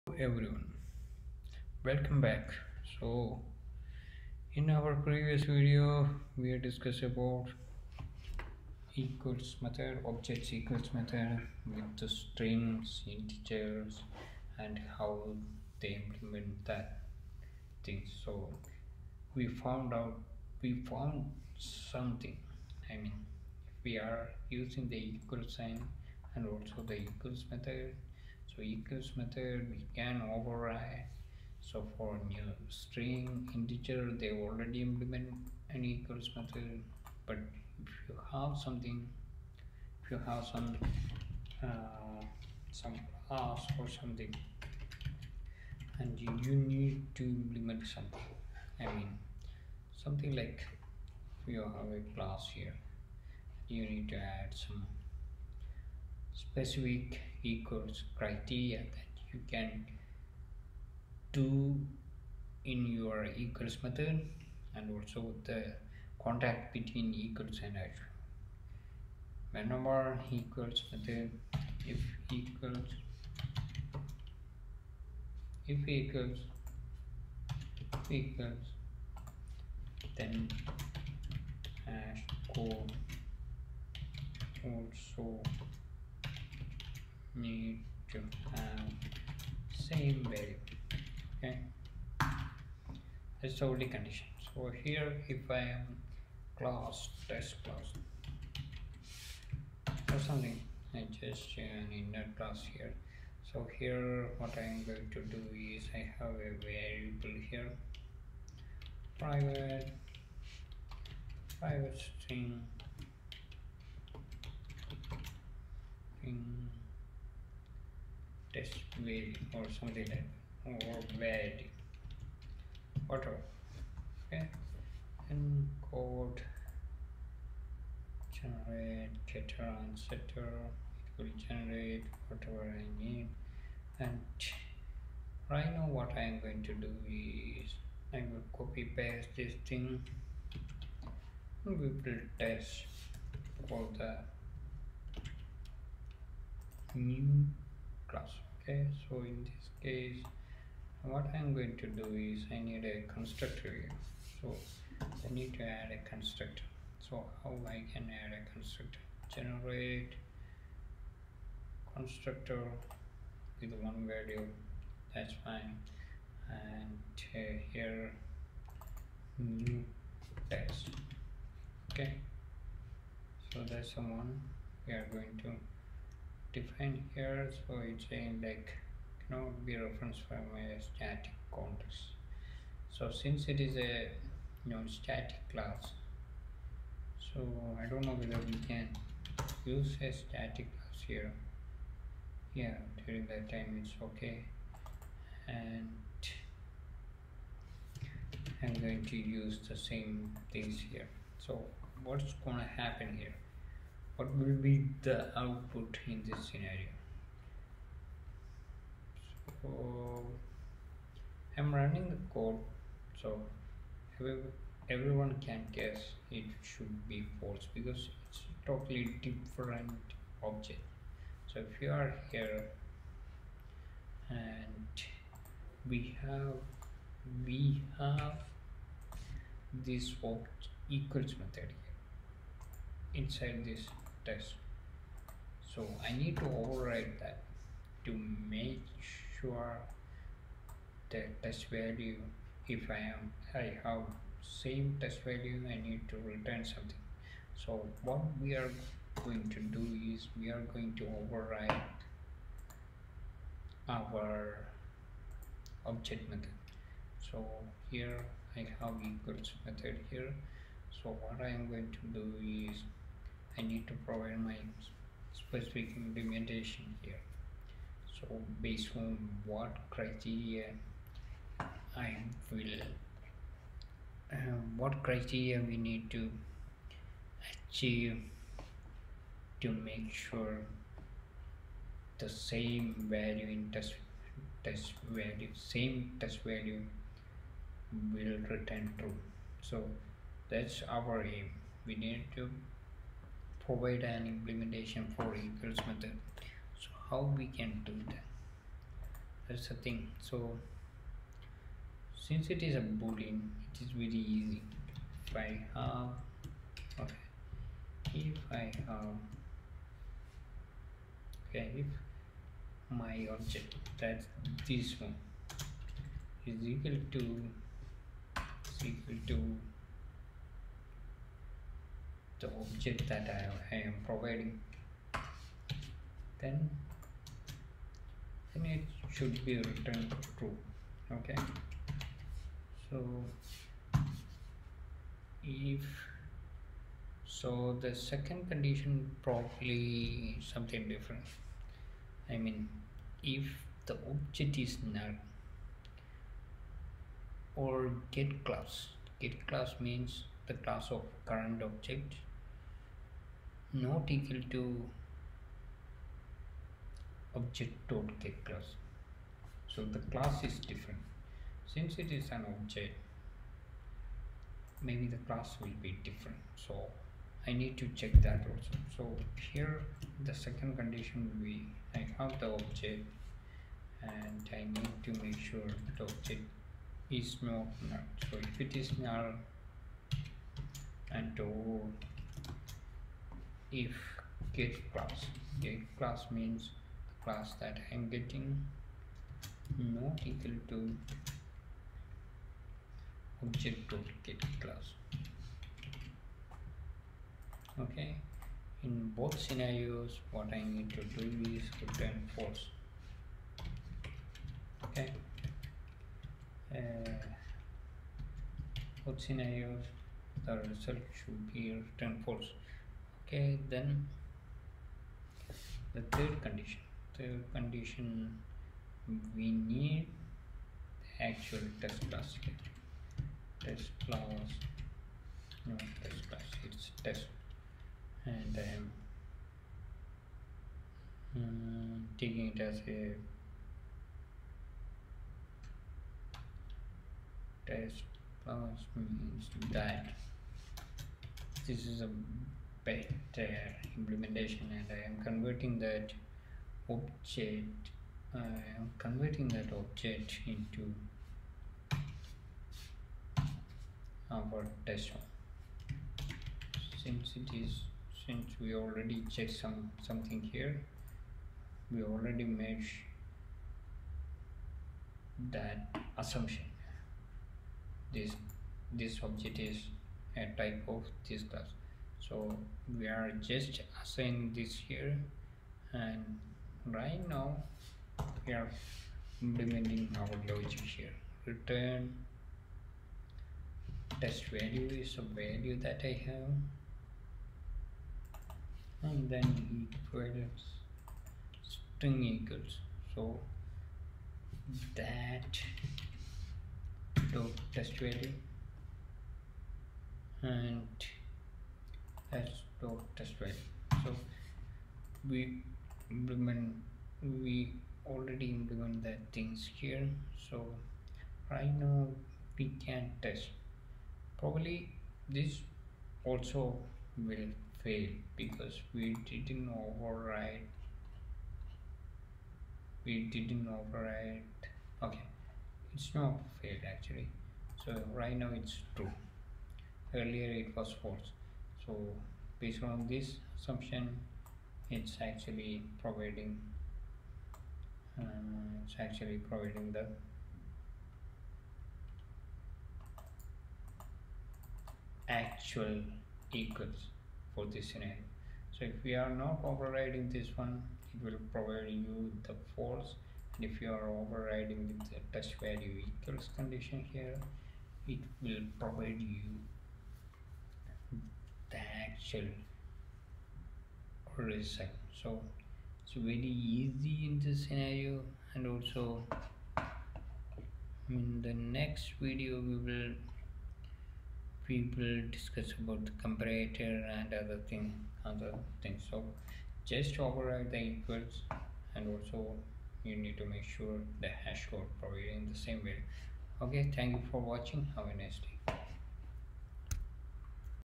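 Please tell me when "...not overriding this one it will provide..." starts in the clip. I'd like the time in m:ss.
9:09.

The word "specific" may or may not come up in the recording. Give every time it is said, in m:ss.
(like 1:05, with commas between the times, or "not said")
0:56, 4:25.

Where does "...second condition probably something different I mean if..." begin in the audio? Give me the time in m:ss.
5:37.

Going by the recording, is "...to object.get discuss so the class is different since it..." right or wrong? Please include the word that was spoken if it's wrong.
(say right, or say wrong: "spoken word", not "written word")
wrong: "class", not "discuss".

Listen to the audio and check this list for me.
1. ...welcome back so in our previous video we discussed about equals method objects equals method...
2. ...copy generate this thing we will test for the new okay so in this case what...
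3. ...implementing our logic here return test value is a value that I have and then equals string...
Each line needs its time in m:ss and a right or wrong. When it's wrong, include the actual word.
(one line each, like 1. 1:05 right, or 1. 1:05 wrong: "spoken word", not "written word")
1. 0:01 right
2. 2:18 wrong: "paste", not "generate"
3. 7:59 right.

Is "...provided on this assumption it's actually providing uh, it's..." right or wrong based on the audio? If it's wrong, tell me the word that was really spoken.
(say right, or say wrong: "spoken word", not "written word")
wrong: "based", not "provided".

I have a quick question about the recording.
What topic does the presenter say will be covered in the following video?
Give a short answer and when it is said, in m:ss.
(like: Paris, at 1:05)
the comparator, at 9:36.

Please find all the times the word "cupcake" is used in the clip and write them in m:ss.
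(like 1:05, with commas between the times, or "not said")
not said.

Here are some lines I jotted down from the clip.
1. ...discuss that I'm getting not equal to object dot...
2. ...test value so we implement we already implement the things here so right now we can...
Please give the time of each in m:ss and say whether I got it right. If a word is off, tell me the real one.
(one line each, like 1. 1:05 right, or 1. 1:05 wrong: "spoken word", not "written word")
1. 6:27 wrong: "class", not "discuss"
2. 8:23 right.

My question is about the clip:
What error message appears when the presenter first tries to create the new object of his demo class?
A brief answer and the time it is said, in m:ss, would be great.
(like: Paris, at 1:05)
cannot be referenced from a static context, at 2:59.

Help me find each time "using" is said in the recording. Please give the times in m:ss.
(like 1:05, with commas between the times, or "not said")
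0:24.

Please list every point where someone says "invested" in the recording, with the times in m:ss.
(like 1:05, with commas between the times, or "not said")
not said.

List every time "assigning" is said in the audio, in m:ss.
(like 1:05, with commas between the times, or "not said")
7:54.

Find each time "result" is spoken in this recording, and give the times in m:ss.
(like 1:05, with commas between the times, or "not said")
6:50, 9:24.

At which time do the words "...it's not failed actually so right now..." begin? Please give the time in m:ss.
8:45.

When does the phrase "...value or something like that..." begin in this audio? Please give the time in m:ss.
1:58.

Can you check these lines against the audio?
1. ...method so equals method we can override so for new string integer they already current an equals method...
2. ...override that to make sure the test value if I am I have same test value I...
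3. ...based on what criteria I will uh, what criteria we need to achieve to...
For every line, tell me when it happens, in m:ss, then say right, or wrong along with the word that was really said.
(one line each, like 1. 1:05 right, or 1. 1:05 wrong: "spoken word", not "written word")
1. 0:27 wrong: "implement", not "current"
2. 3:56 right
3. 4:28 right.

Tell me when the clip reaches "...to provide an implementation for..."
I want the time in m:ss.
4:52.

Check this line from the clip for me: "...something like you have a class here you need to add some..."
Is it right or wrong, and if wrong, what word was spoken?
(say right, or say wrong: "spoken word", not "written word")
right.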